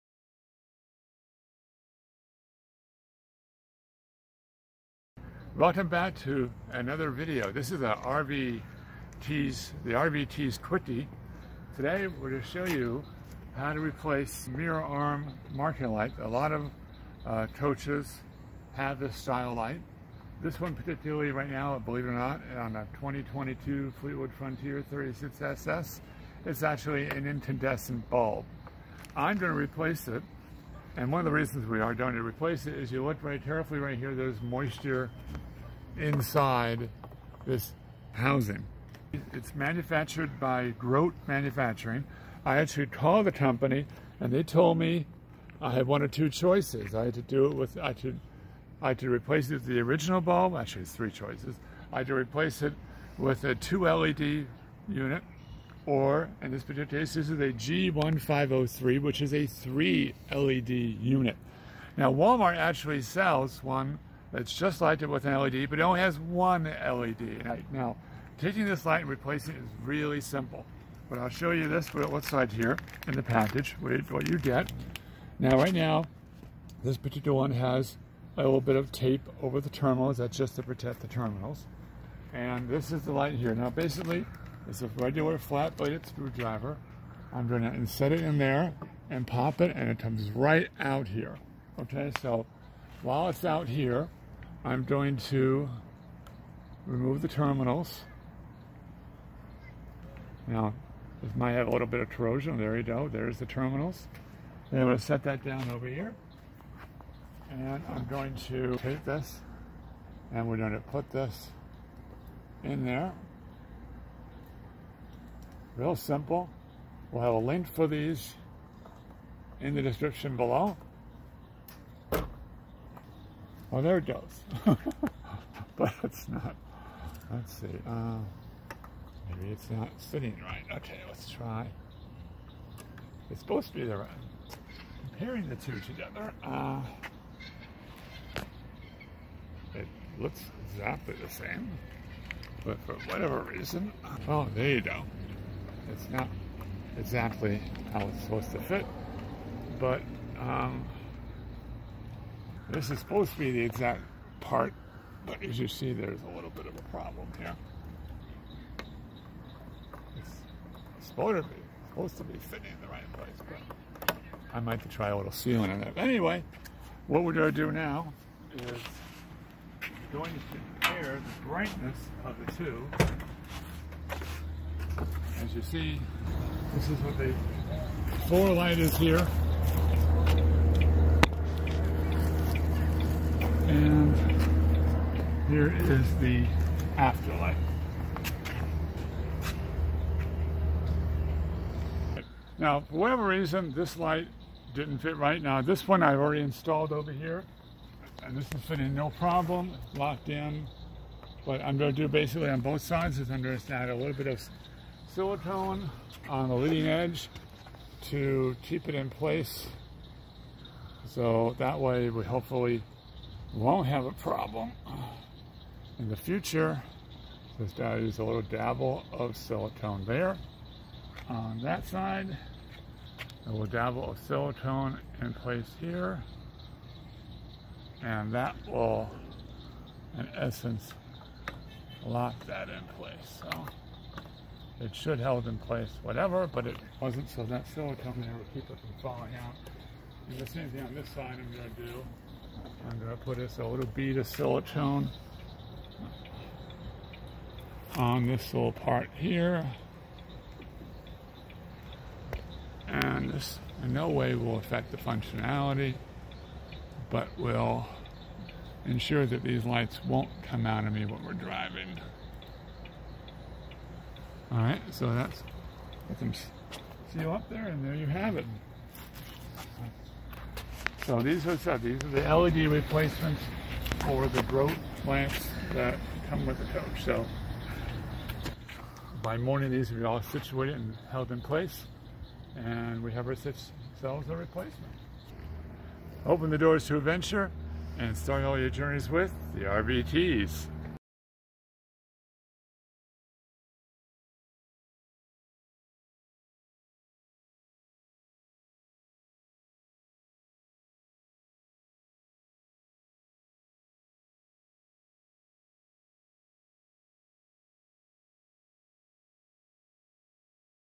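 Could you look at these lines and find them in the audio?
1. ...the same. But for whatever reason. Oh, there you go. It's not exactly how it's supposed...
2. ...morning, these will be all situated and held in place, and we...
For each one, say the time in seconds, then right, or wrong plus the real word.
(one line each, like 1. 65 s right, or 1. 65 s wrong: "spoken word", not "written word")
1. 141 s right
2. 279 s right.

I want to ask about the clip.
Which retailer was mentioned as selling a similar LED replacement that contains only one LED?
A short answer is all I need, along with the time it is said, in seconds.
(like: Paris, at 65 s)
Walmart, at 62 s.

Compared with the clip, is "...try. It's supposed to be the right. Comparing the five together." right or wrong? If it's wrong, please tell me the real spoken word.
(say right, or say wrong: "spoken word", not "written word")
wrong: "two", not "five".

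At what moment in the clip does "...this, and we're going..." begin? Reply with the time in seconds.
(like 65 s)
109 s.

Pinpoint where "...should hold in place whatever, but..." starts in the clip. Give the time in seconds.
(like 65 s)
234 s.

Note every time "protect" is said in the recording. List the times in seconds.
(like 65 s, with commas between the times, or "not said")
80 s.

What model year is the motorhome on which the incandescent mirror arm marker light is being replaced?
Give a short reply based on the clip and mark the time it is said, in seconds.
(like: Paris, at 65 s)
2022, at 22 s.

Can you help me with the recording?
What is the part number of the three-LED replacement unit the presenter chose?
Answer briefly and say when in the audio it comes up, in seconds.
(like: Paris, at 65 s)
G1503, at 57 s.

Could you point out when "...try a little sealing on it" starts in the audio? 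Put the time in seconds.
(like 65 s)
164 s.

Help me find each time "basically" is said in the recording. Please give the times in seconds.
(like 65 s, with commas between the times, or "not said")
83 s, 202 s.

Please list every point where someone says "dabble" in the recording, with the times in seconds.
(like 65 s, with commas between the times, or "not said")
218 s, 223 s.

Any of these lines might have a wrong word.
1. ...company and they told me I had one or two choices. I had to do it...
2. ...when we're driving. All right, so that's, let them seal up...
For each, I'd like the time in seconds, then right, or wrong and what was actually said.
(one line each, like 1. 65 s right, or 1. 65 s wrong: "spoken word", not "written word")
1. 43 s right
2. 261 s right.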